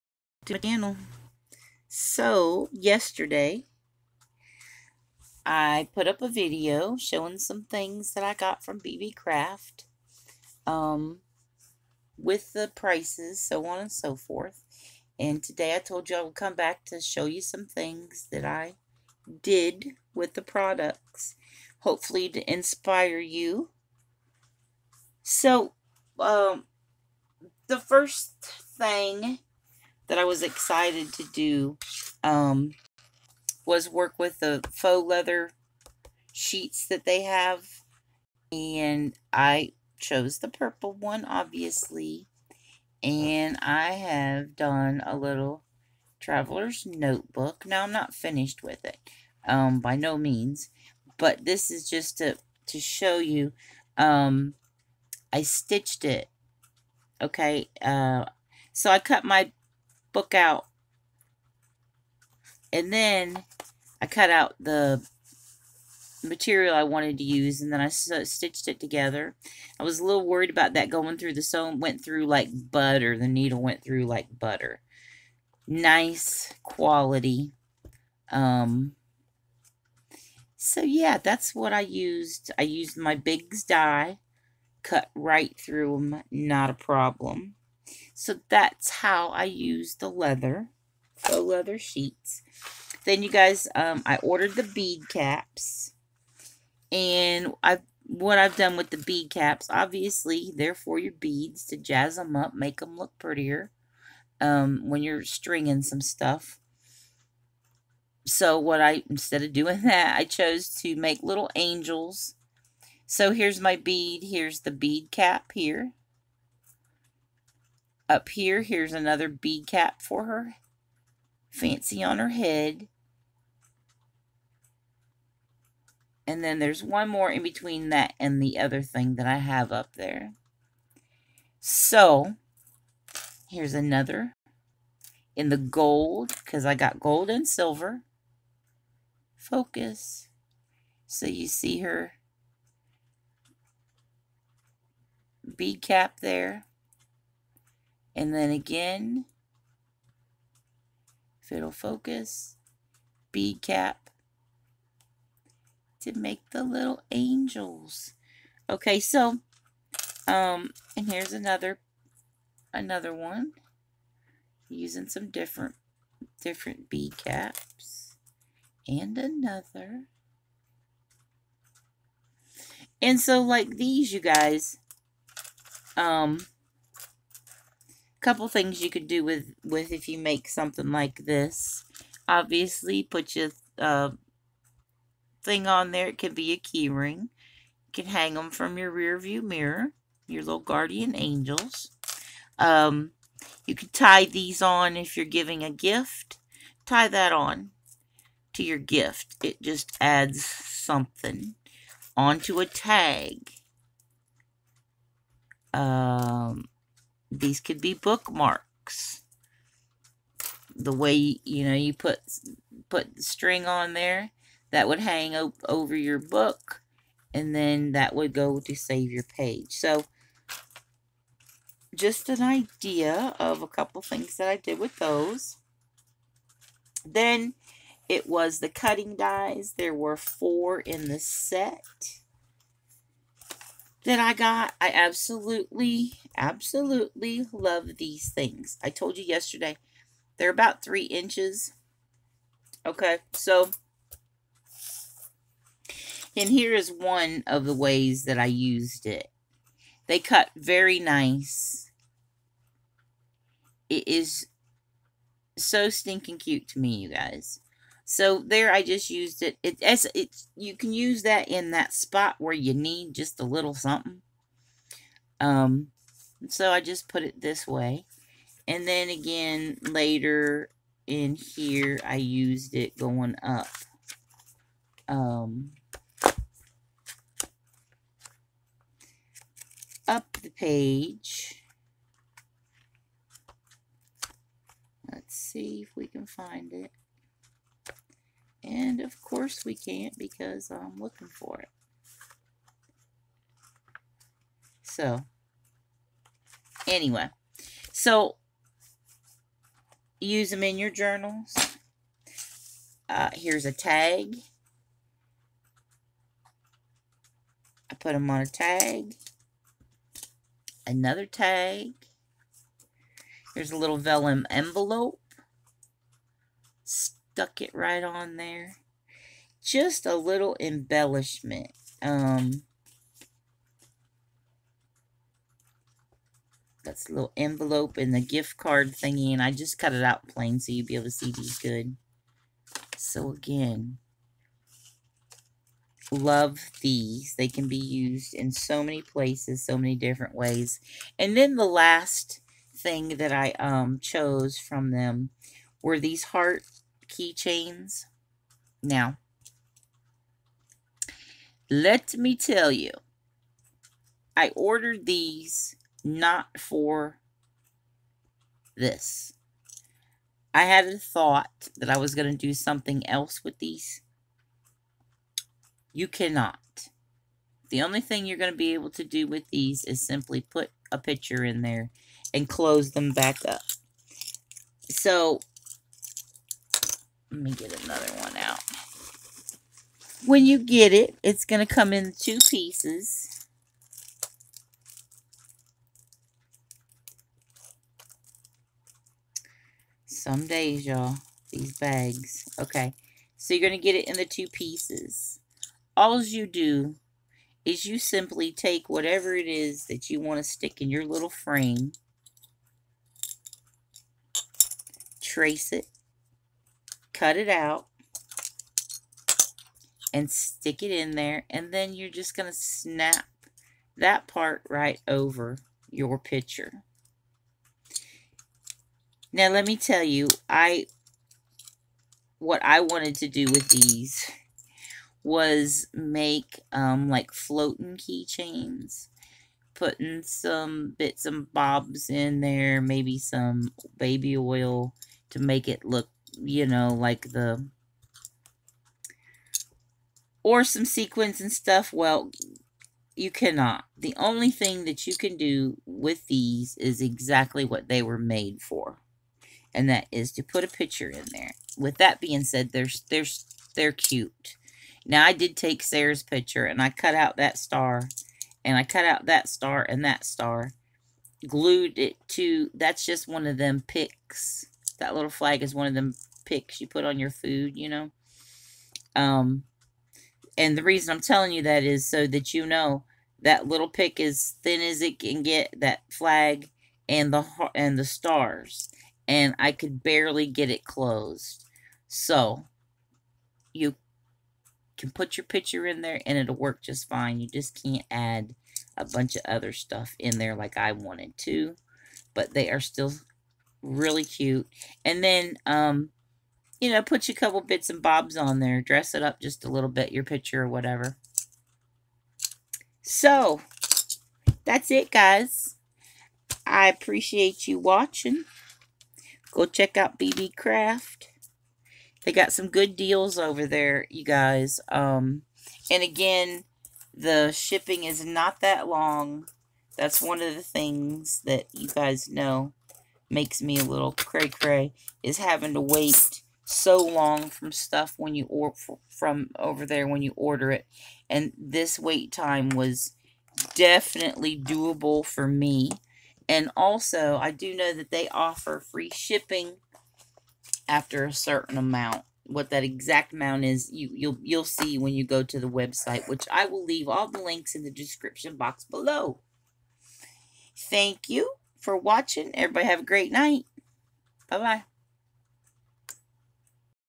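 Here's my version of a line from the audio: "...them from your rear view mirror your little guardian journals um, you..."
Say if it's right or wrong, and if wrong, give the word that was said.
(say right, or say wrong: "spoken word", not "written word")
wrong: "angels", not "journals".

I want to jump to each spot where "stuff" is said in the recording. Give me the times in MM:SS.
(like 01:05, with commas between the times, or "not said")
01:46, 07:21, 08:09, 08:47.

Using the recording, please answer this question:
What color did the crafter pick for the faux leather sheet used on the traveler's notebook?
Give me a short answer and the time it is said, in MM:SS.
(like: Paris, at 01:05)
Purple, at 00:40.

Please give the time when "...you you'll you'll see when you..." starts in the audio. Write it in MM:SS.
09:03.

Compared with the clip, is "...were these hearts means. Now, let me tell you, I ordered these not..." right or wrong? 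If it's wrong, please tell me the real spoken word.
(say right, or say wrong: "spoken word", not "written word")
wrong: "keychains", not "means".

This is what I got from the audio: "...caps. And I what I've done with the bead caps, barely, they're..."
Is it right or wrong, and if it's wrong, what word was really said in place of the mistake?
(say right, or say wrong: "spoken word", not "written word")
wrong: "obviously", not "barely".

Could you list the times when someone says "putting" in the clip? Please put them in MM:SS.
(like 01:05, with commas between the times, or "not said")
07:09.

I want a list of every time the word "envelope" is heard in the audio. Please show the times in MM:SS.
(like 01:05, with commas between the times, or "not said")
05:14, 05:27.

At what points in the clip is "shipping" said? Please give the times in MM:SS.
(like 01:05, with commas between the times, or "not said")
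08:37, 08:59.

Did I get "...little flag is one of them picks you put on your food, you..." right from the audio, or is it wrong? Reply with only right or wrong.
right.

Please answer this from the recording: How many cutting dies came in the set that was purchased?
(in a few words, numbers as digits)
4.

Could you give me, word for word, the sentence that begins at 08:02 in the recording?
So you can put your picture in there, and it'll work just fine.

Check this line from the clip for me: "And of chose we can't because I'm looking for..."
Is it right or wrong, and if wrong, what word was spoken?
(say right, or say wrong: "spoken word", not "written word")
wrong: "course", not "chose".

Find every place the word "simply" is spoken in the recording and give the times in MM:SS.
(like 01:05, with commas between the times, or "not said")
06:10, 06:37.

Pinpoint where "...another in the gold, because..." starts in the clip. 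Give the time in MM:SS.
02:13.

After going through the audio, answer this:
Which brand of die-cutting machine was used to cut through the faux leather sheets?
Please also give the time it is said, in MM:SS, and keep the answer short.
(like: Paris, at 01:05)
Biggs, at 01:23.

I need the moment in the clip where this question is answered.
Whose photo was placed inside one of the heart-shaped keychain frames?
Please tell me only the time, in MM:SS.
07:35.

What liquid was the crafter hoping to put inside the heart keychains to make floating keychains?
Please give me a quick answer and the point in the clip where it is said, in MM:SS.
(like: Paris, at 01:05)
Baby oil, at 07:13.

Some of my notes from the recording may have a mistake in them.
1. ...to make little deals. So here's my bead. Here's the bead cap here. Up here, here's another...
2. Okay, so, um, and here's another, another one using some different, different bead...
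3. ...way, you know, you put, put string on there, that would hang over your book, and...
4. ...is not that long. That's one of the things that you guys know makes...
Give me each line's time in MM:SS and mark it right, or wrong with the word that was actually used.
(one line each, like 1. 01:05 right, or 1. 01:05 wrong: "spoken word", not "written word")
1. 01:50 wrong: "angels", not "deals"
2. 02:38 right
3. 03:30 right
4. 08:38 right.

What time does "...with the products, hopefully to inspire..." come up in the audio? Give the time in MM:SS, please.
00:20.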